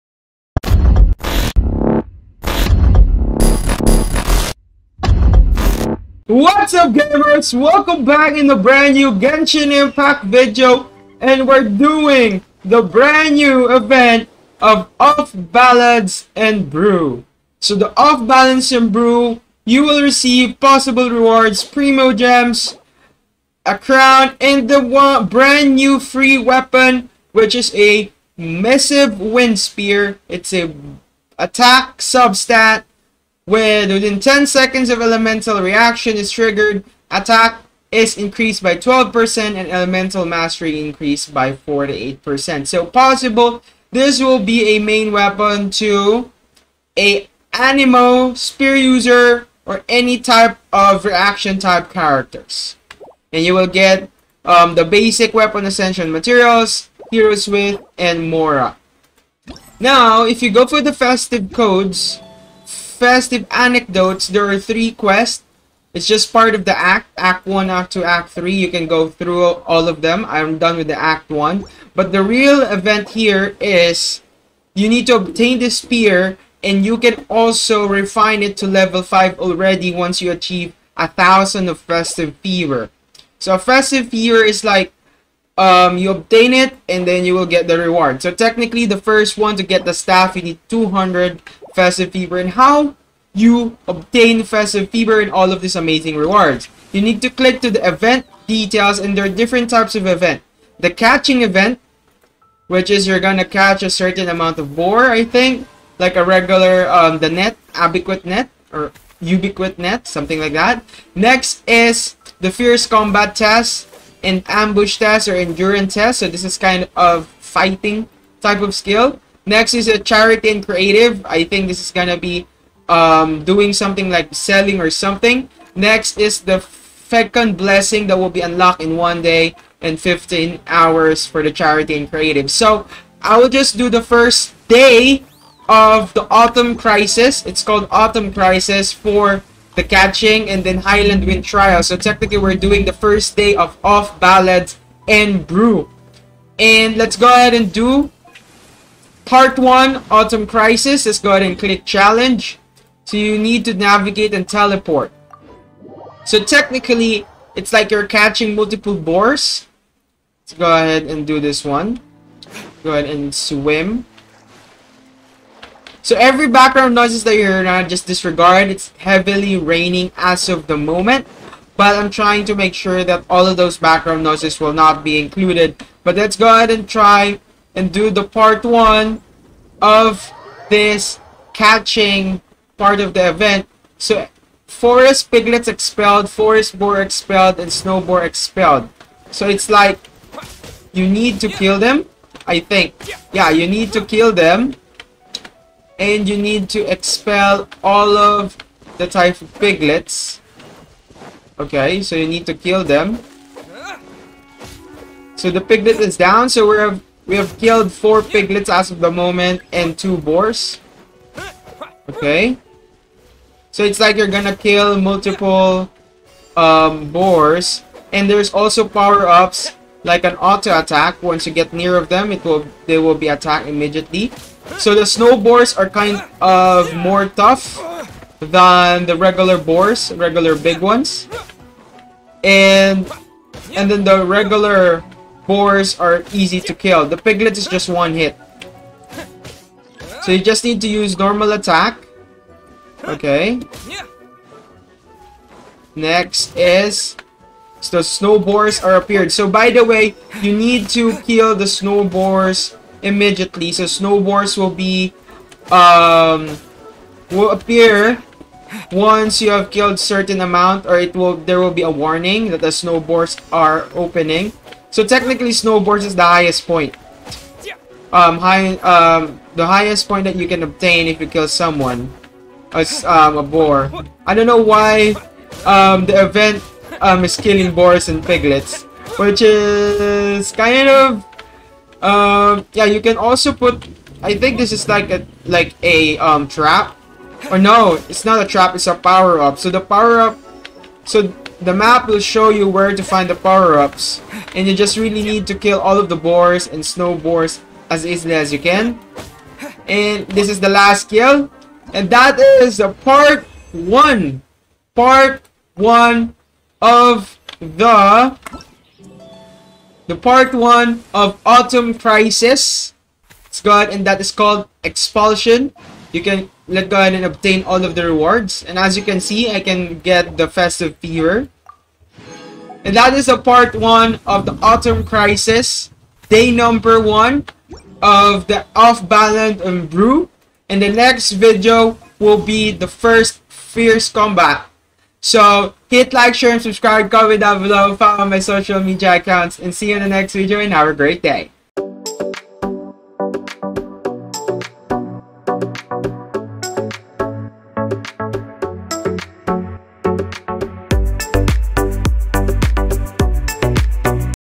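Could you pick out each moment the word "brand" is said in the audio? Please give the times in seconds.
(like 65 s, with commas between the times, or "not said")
8 s, 12 s, 25 s.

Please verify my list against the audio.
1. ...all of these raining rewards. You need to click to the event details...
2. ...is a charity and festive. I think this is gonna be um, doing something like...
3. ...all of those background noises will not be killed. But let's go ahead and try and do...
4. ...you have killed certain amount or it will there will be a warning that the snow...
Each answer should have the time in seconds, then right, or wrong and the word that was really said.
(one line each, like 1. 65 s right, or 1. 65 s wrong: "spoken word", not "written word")
1. 95 s wrong: "amazing", not "raining"
2. 119 s wrong: "creative", not "festive"
3. 173 s wrong: "included", not "killed"
4. 259 s right.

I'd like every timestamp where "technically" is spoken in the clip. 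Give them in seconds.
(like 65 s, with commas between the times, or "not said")
88 s, 141 s, 156 s, 265 s.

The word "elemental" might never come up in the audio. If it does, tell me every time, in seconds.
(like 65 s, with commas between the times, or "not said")
35 s, 39 s.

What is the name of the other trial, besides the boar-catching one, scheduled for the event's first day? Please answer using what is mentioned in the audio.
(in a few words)
Highland Wind Trial.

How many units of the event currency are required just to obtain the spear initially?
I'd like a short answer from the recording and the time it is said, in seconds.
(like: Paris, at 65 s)
200, at 90 s.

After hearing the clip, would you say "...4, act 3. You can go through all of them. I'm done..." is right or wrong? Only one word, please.
wrong.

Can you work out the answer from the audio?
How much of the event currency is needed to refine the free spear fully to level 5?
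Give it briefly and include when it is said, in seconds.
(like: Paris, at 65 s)
1000, at 80 s.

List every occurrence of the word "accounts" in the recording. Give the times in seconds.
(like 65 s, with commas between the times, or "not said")
339 s.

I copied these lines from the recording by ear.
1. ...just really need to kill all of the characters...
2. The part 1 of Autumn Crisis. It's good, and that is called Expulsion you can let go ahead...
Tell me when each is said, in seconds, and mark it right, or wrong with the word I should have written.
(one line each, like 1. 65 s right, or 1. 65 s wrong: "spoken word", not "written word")
1. 294 s wrong: "boars", not "characters"
2. 310 s right.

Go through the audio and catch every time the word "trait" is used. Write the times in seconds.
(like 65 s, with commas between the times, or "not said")
not said.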